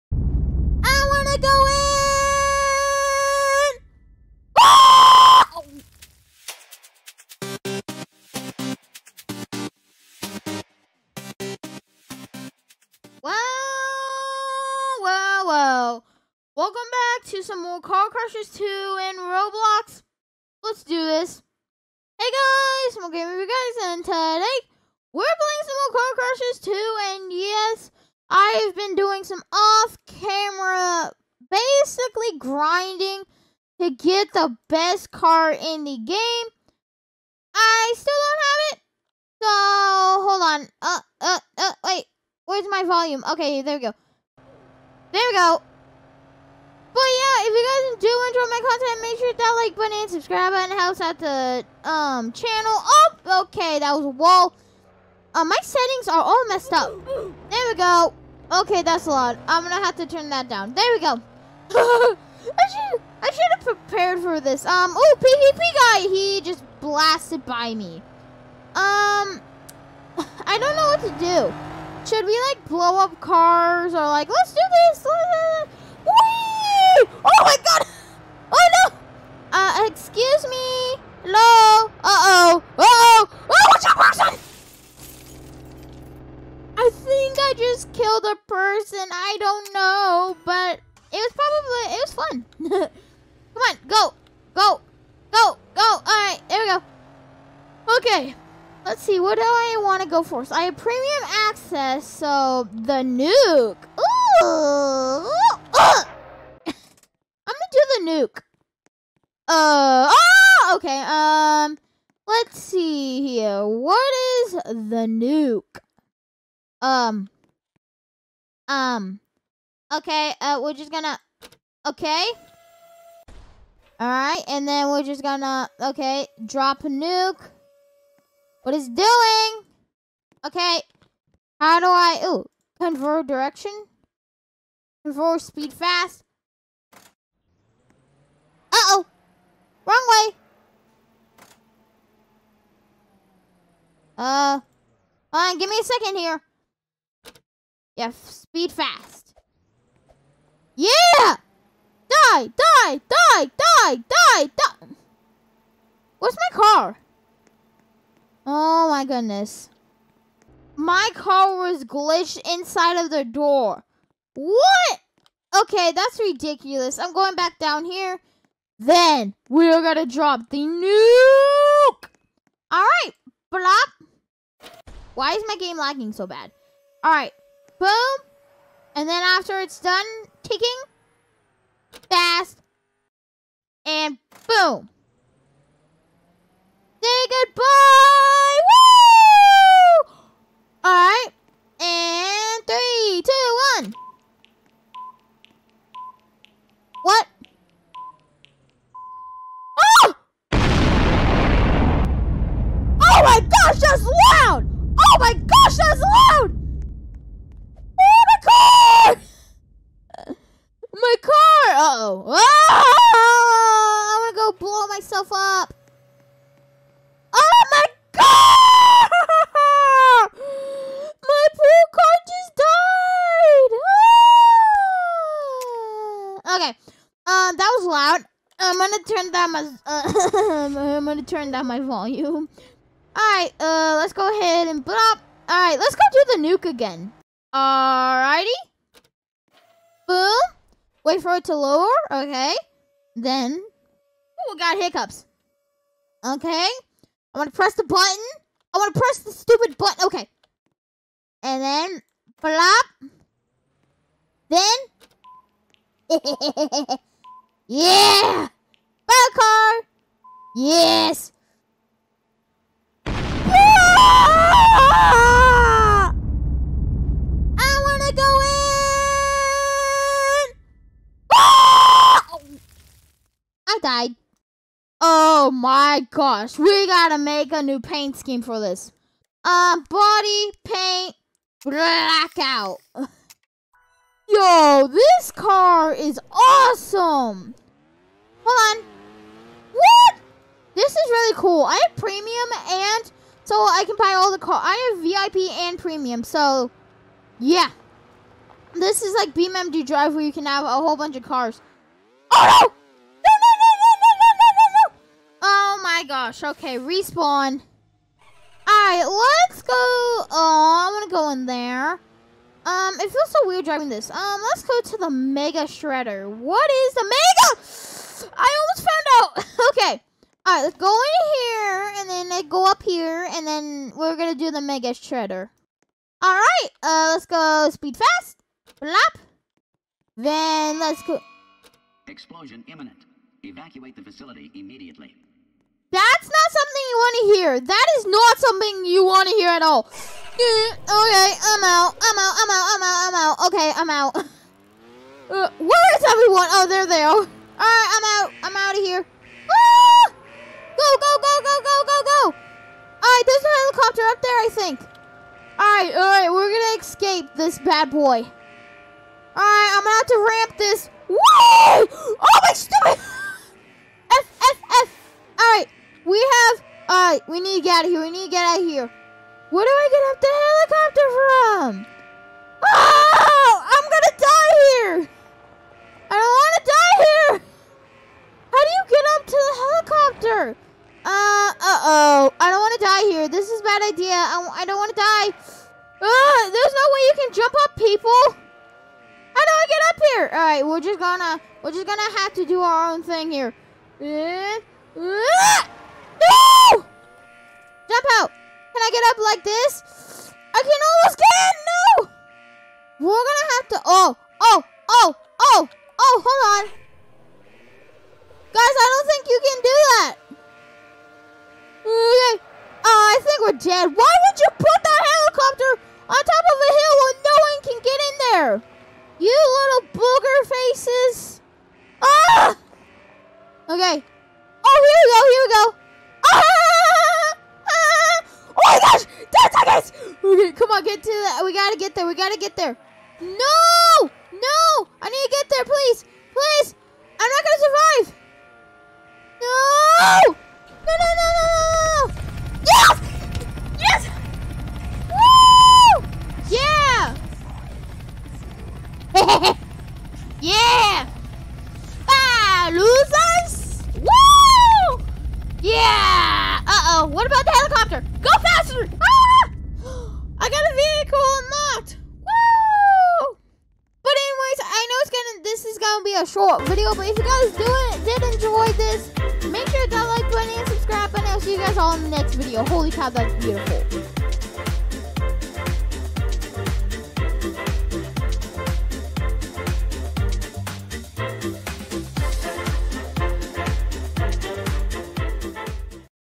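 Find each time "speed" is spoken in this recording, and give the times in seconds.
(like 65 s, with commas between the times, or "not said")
135 s, 148 s, 327 s.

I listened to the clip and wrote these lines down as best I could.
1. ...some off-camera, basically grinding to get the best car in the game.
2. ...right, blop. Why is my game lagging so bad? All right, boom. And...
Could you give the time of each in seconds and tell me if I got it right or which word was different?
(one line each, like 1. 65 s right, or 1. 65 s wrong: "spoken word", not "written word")
1. 29 s right
2. 172 s right.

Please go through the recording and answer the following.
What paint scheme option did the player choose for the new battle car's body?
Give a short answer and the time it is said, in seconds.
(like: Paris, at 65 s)
blackout, at 279 s.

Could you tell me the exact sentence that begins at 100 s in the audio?
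So I have premium access, so the nuke.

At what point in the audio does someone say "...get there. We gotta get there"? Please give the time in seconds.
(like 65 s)
431 s.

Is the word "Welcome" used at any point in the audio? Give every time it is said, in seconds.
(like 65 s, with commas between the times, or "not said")
16 s.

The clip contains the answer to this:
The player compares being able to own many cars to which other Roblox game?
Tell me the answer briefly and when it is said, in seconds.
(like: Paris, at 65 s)
BMW Drive, at 299 s.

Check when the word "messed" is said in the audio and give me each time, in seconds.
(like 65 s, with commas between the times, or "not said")
56 s.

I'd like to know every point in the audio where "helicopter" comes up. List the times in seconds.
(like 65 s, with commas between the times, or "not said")
353 s, 370 s, 379 s, 457 s.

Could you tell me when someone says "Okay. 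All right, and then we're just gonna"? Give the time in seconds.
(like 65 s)
121 s.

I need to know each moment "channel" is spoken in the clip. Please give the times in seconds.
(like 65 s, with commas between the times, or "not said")
52 s.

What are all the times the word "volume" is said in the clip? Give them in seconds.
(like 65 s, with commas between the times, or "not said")
42 s, 231 s.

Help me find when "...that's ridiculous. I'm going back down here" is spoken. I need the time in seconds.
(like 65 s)
165 s.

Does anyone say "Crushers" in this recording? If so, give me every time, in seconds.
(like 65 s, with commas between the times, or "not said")
18 s, 26 s.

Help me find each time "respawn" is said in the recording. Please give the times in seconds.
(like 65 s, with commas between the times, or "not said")
306 s.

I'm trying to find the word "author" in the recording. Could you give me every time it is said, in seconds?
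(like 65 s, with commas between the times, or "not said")
not said.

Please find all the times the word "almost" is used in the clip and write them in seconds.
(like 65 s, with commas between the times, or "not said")
318 s, 400 s.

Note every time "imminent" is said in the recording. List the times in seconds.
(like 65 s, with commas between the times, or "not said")
332 s.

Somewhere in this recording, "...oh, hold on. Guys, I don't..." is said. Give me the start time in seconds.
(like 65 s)
405 s.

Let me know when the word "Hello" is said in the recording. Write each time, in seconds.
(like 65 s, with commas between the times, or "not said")
15 s, 81 s.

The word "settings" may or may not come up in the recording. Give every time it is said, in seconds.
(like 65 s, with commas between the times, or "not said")
55 s.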